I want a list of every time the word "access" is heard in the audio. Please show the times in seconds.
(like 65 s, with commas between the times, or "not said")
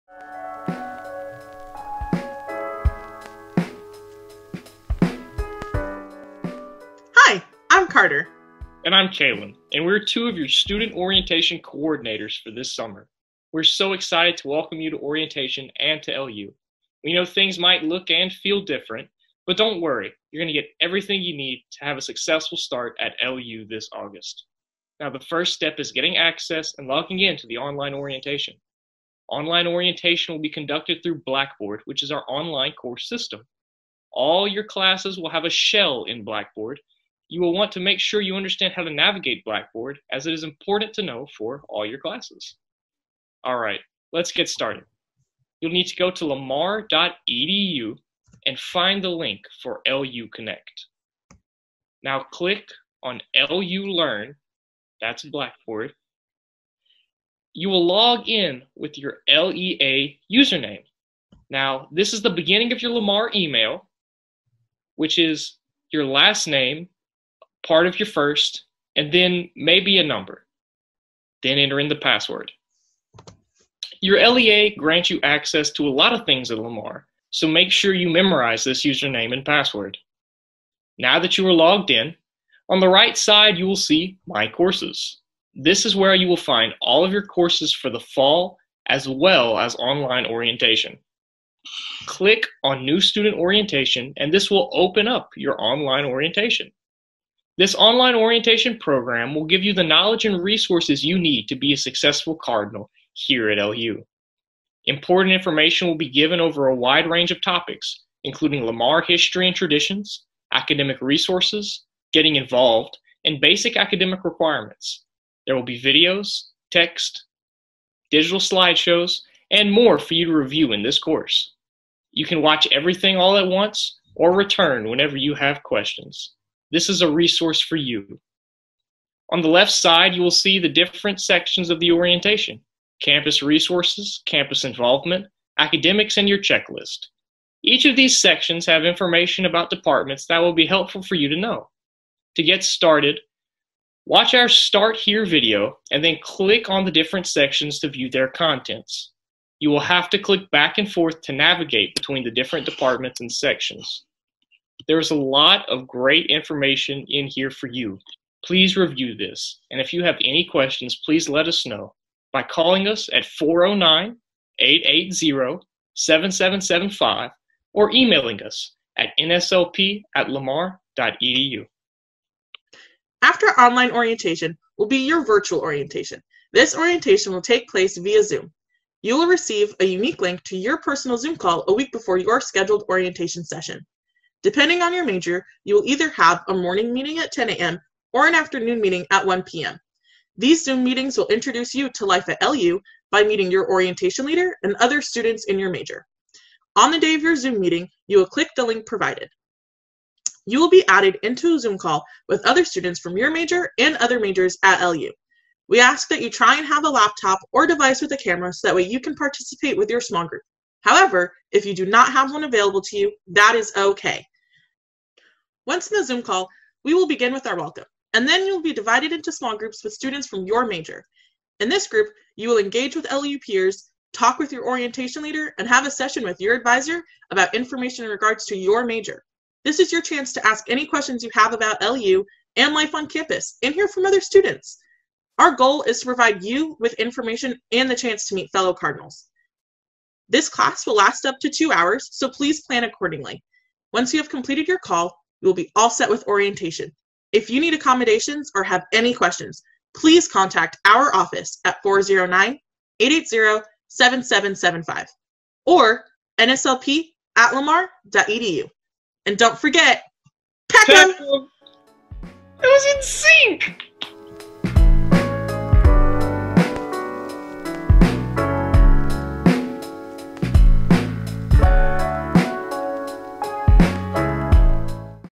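26 s, 75 s.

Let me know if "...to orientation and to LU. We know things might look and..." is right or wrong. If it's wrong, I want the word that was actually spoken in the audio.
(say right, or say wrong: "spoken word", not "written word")
right.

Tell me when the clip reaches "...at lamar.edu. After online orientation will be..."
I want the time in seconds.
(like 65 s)
170 s.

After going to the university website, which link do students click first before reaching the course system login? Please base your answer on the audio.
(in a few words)
LU Connect.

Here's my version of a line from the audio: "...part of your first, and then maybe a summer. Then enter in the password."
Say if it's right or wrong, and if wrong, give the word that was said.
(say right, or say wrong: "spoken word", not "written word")
wrong: "number", not "summer".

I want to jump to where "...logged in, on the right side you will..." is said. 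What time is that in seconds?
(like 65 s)
81 s.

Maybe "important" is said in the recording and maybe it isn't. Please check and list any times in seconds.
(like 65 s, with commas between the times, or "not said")
40 s, 104 s.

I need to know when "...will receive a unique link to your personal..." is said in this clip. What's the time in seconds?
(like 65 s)
179 s.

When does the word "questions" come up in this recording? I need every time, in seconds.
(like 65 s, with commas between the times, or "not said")
125 s, 160 s, 230 s, 249 s.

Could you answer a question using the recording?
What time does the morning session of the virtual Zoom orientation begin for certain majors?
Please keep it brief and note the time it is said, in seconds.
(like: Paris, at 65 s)
10 a.m., at 187 s.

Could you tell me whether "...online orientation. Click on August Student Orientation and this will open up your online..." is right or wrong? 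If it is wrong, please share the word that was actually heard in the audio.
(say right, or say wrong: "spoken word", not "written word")
wrong: "New", not "August".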